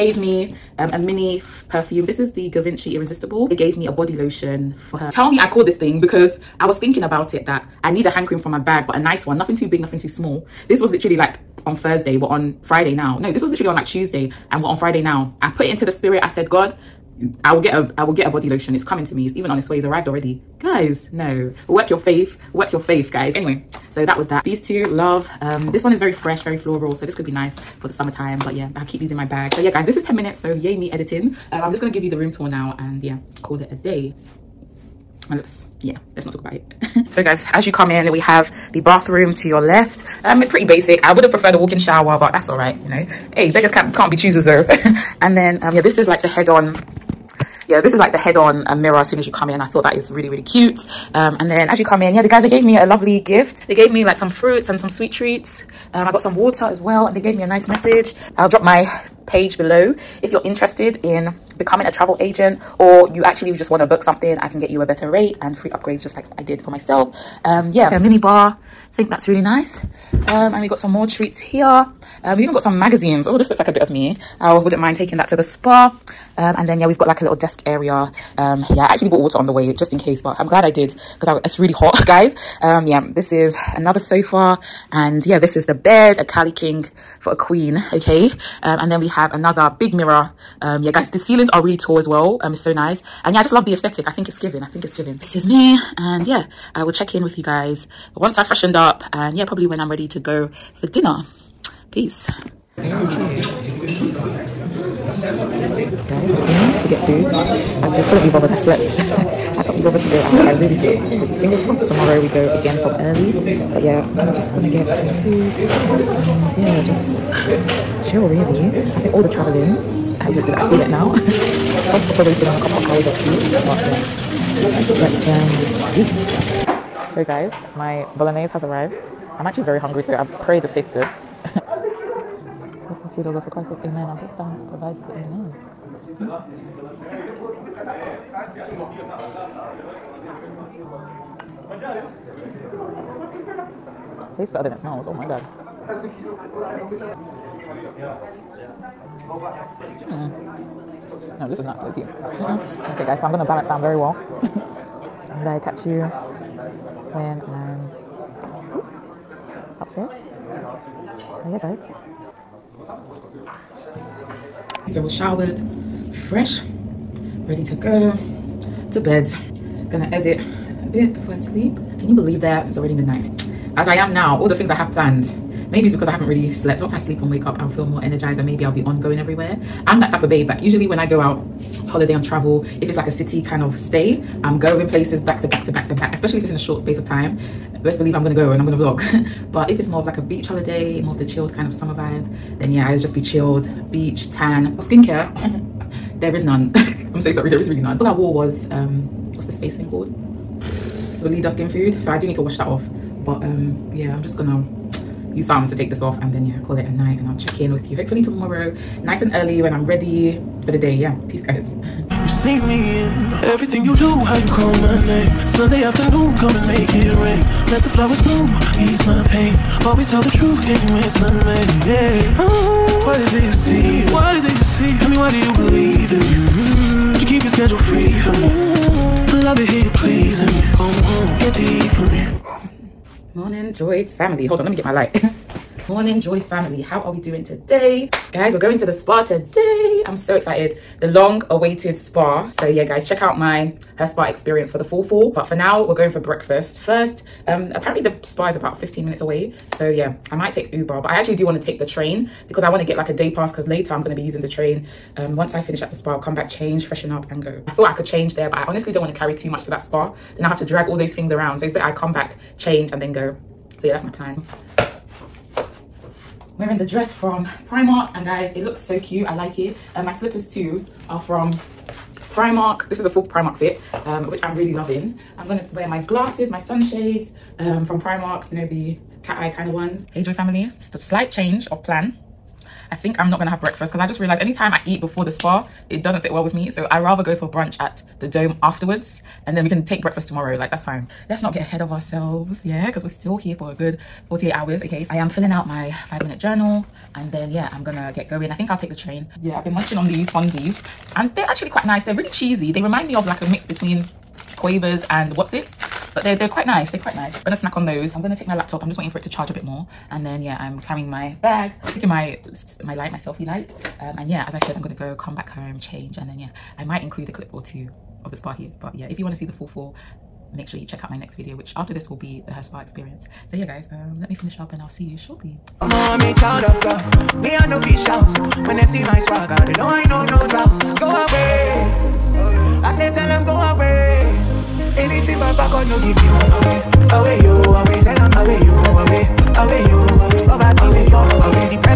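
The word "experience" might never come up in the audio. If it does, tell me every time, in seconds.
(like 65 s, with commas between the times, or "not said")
244 s, 322 s.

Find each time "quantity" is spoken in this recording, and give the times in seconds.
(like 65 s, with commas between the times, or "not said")
not said.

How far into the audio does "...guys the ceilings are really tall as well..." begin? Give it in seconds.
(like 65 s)
90 s.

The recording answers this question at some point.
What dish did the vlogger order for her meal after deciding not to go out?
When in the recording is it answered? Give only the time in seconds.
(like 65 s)
128 s.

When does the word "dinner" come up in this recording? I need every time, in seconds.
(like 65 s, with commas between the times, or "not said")
100 s.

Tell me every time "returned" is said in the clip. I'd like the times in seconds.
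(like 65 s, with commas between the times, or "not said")
not said.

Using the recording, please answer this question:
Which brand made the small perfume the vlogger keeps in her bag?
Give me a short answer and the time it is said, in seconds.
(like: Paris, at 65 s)
Givenchy, at 2 s.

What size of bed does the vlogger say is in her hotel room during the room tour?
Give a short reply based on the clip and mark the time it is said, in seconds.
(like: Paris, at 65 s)
Cali King, at 86 s.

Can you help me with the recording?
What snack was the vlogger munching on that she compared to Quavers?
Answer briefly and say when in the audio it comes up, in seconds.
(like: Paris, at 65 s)
Fonzies, at 300 s.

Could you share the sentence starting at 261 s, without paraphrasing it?
So it's better I come back, change and then go.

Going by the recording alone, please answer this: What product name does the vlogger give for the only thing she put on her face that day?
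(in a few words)
Weleda Skin Food.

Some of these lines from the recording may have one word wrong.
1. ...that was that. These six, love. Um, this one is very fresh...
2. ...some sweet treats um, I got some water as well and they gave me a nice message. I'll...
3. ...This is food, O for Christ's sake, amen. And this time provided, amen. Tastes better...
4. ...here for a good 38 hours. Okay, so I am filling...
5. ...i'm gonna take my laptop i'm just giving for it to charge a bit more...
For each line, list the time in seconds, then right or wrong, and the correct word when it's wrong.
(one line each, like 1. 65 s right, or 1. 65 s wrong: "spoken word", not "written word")
1. 24 s wrong: "two", not "six"
2. 54 s right
3. 132 s right
4. 293 s wrong: "48", not "38"
5. 308 s wrong: "waiting", not "giving".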